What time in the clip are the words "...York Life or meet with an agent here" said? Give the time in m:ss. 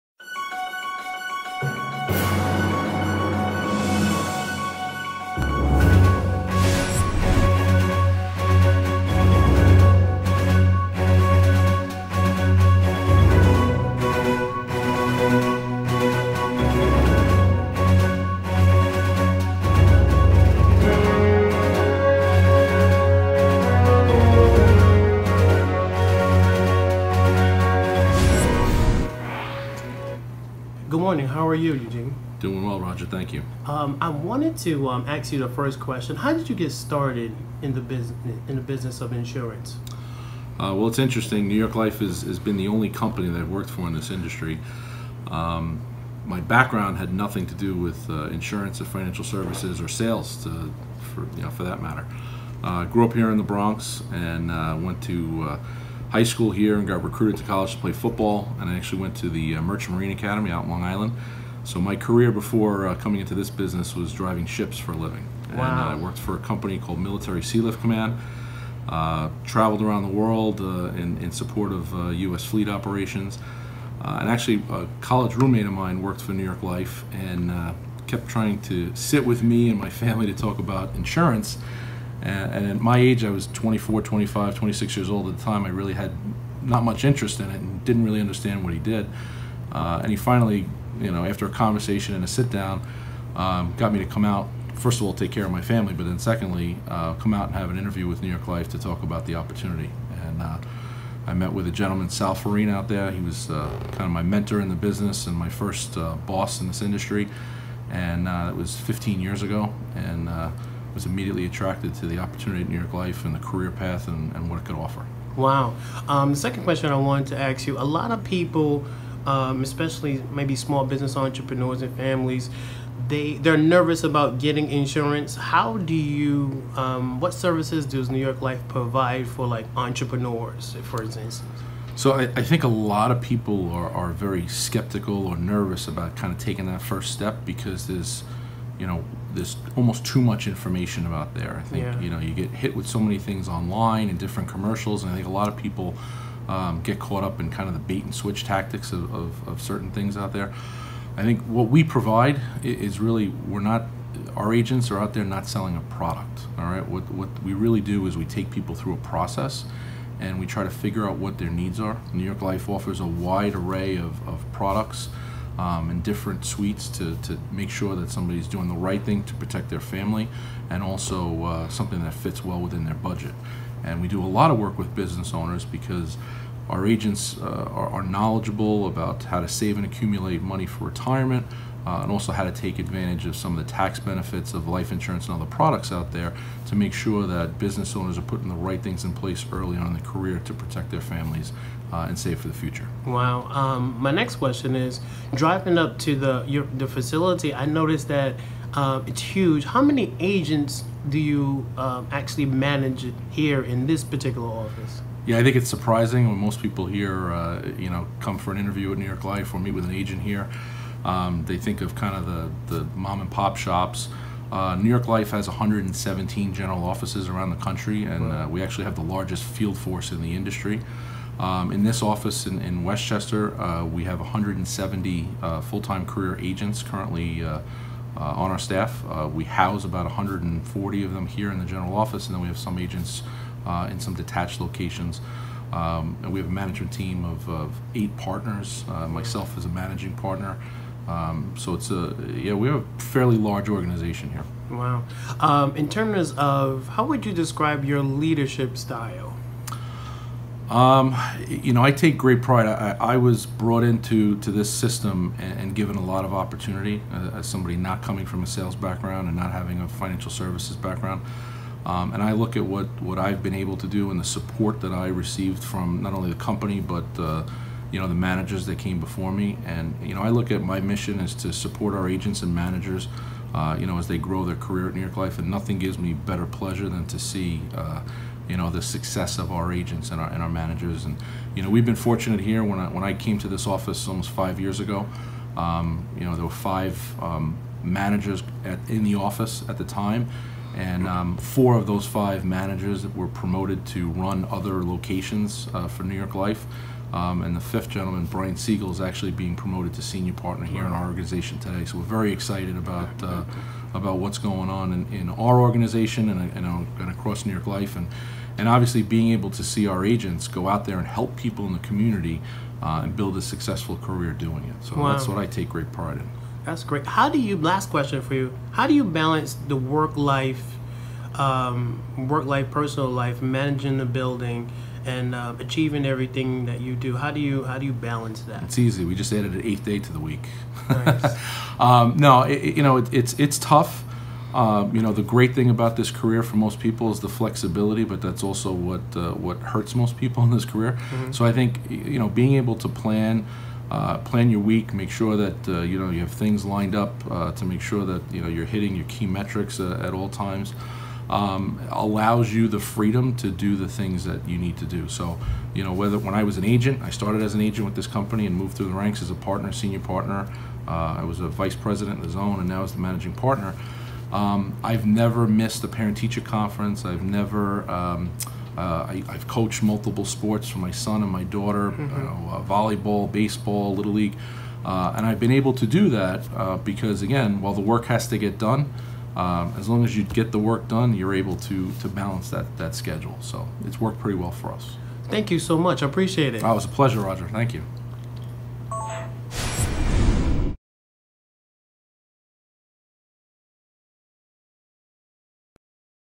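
3:29.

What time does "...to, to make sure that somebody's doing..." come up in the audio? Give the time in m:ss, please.
2:46.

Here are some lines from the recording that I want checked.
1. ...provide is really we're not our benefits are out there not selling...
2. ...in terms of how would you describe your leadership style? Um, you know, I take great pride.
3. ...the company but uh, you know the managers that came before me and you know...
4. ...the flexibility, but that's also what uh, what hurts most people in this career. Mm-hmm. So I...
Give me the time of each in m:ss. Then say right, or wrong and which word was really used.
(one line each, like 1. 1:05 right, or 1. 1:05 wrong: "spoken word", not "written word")
1. 2:31 wrong: "agents", not "benefits"
2. 4:05 right
3. 4:26 right
4. 5:37 right.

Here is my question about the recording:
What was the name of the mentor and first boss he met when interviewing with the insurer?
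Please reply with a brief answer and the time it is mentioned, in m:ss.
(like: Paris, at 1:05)
Sal Farina, at 1:42.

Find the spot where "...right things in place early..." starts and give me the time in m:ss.
3:08.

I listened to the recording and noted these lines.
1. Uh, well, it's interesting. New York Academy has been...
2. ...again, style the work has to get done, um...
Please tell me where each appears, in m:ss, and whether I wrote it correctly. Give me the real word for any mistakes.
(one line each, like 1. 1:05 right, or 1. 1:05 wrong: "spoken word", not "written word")
1. 0:40 wrong: "Life", not "Academy"
2. 6:17 wrong: "while", not "style".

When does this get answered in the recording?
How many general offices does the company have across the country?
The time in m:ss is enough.
3:35.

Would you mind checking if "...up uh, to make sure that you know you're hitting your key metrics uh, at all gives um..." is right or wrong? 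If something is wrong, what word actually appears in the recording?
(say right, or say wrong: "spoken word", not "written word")
wrong: "times", not "gives".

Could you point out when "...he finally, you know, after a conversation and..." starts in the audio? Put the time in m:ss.
1:30.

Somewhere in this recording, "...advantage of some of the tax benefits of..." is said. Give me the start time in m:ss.
3:02.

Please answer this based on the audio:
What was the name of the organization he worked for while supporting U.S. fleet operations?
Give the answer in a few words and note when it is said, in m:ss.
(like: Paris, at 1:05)
Military Sealift Command, at 1:06.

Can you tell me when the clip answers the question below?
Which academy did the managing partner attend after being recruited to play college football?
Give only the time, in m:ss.
0:59.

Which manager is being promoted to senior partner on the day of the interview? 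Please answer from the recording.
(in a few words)
Brian Siegel.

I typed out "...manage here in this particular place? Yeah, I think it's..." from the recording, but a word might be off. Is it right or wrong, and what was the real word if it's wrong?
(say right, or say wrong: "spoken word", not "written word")
wrong: "office", not "place".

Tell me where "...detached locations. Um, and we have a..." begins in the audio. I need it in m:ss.
3:54.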